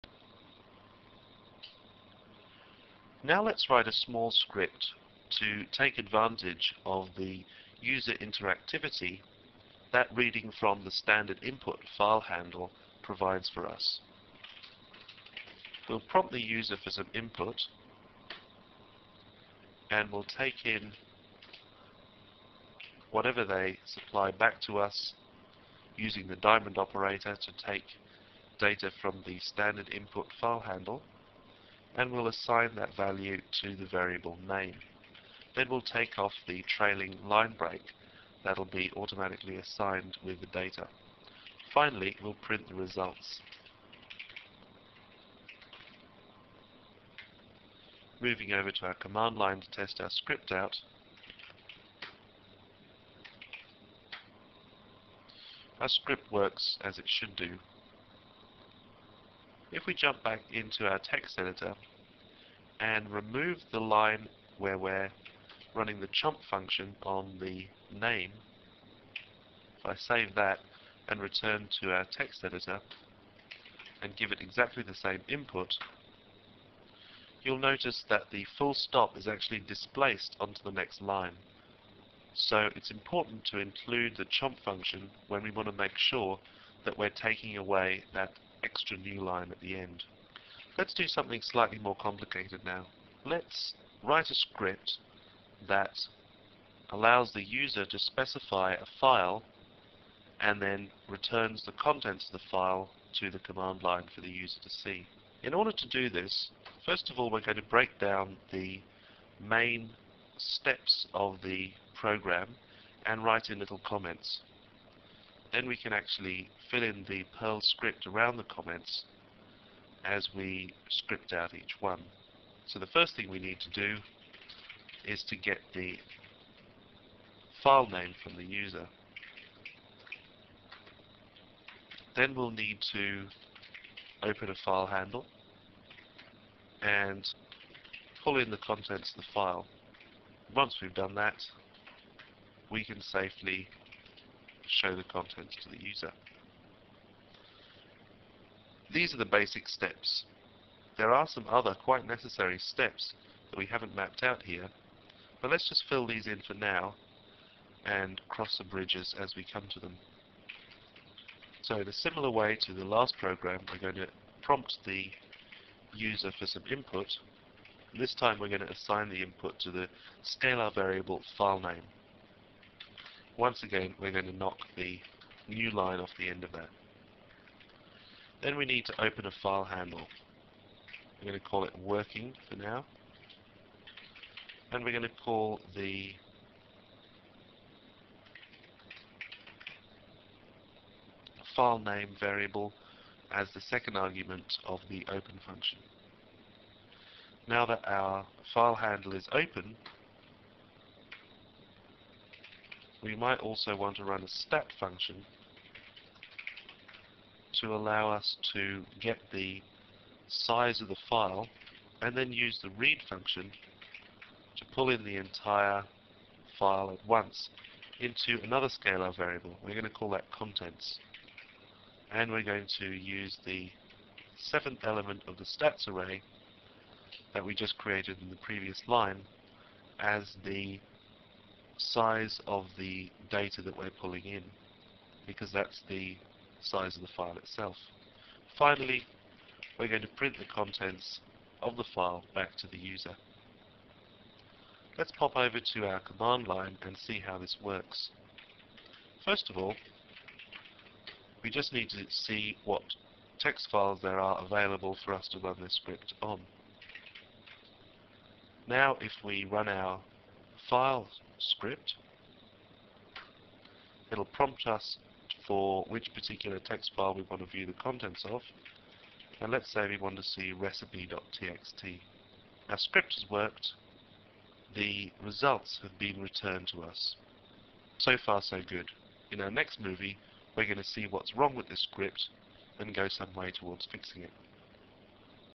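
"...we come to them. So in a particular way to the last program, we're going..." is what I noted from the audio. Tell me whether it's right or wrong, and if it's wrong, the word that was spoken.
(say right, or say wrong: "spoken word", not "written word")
wrong: "similar", not "particular".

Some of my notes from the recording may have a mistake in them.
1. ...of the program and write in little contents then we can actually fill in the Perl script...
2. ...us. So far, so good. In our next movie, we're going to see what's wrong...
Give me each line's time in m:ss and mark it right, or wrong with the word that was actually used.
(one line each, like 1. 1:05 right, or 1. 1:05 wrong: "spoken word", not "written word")
1. 1:51 wrong: "comments", not "contents"
2. 4:36 right.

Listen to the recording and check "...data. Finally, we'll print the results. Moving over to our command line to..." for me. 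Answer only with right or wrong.
right.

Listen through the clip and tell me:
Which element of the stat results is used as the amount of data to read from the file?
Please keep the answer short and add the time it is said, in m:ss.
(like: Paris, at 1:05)
seventh, at 3:44.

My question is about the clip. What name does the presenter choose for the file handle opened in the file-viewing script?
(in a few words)
working.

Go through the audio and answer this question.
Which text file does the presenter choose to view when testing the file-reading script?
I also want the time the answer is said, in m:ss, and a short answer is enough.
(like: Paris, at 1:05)
recipe.txt, at 4:30.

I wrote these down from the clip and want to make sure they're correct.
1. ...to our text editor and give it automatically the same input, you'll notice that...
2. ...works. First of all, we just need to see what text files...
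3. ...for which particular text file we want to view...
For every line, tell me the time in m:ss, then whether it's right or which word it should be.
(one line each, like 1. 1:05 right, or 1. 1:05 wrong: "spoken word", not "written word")
1. 1:11 wrong: "exactly", not "automatically"
2. 4:07 right
3. 4:25 right.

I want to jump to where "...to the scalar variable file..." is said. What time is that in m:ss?
2:49.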